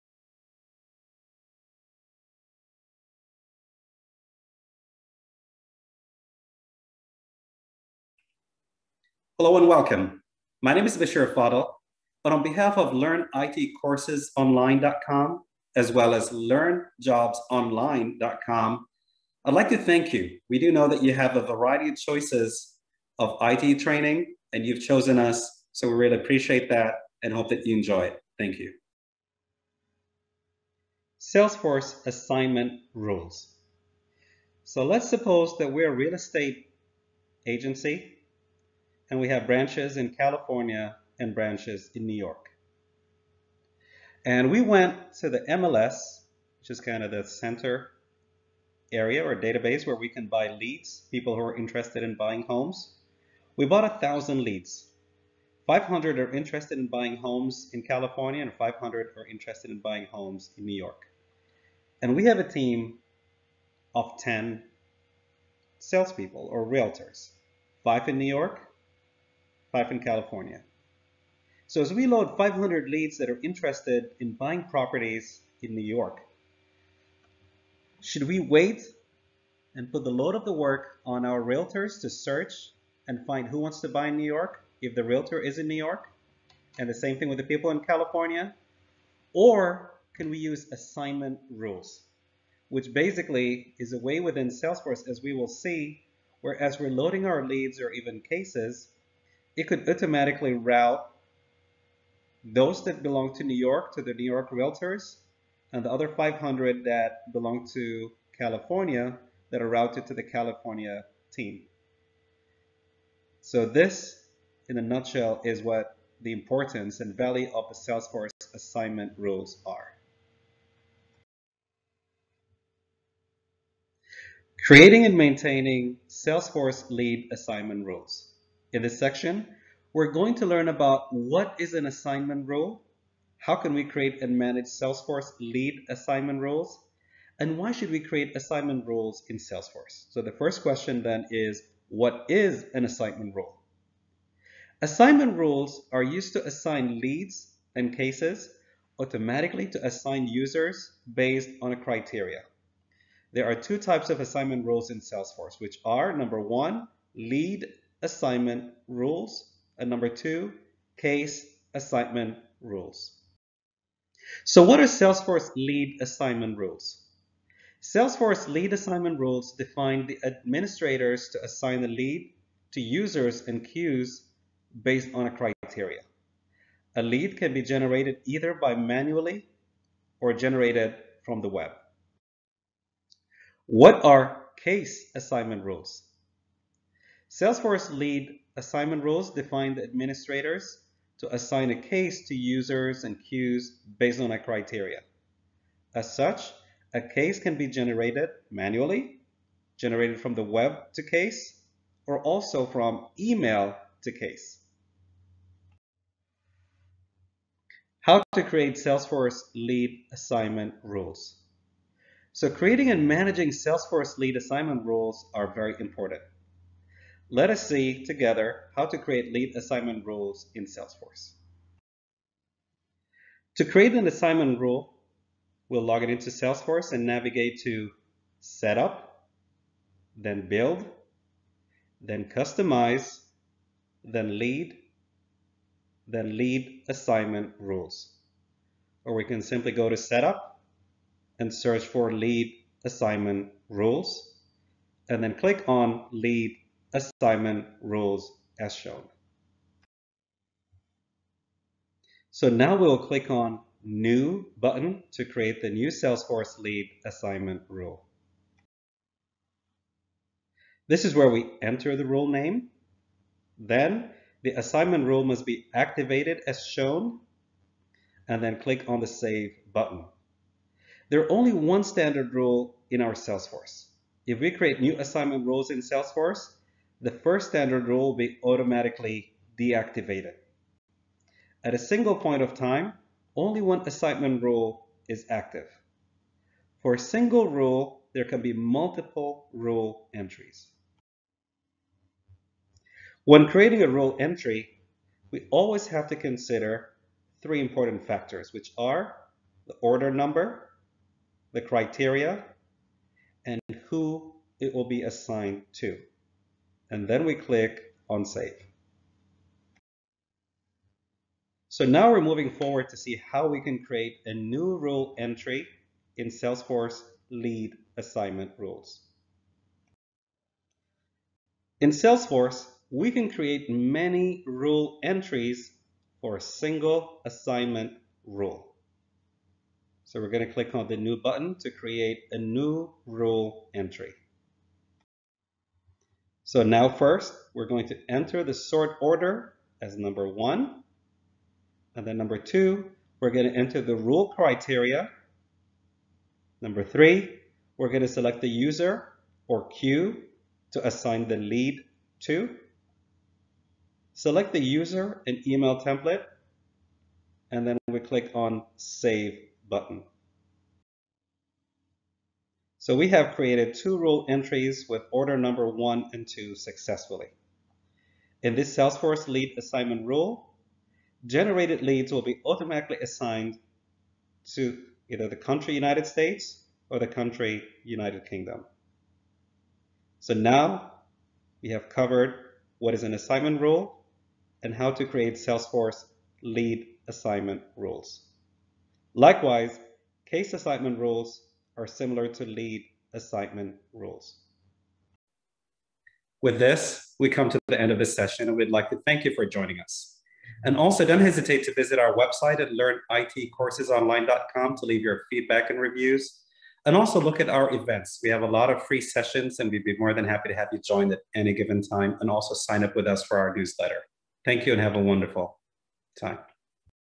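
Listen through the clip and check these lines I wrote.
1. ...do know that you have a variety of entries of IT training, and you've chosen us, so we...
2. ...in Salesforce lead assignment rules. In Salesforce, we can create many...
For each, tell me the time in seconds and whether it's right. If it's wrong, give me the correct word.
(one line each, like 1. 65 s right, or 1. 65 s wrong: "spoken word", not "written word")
1. 20 s wrong: "choices", not "entries"
2. 316 s right.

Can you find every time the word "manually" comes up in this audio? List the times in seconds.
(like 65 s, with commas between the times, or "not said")
178 s, 198 s.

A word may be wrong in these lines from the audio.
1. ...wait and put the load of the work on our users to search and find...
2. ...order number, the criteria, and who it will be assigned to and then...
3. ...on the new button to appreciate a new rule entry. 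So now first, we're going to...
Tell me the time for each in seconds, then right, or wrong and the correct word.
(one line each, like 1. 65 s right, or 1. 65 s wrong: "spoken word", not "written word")
1. 78 s wrong: "realtors", not "users"
2. 299 s right
3. 330 s wrong: "create", not "appreciate".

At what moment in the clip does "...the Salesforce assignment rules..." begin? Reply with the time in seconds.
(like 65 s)
117 s.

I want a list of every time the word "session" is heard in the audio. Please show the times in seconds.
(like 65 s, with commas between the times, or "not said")
398 s, 409 s.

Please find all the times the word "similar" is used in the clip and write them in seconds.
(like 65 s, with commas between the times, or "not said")
391 s.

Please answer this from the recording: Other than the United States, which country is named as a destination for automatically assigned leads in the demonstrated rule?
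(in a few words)
United Kingdom.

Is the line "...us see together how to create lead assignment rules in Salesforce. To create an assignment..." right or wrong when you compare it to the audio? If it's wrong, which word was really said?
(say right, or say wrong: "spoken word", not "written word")
right.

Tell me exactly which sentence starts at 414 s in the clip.
Thank you and have a wonderful time.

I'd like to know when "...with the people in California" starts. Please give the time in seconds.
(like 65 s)
87 s.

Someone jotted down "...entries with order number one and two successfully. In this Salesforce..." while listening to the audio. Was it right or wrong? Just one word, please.
right.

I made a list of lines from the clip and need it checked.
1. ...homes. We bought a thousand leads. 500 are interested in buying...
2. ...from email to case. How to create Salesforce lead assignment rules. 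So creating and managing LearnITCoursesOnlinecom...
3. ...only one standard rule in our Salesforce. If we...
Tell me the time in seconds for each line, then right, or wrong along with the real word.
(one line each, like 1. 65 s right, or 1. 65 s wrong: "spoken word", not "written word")
1. 52 s right
2. 202 s wrong: "Salesforce", not "LearnITCoursesOnlinecom"
3. 271 s right.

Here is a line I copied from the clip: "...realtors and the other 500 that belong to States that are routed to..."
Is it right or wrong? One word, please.
wrong.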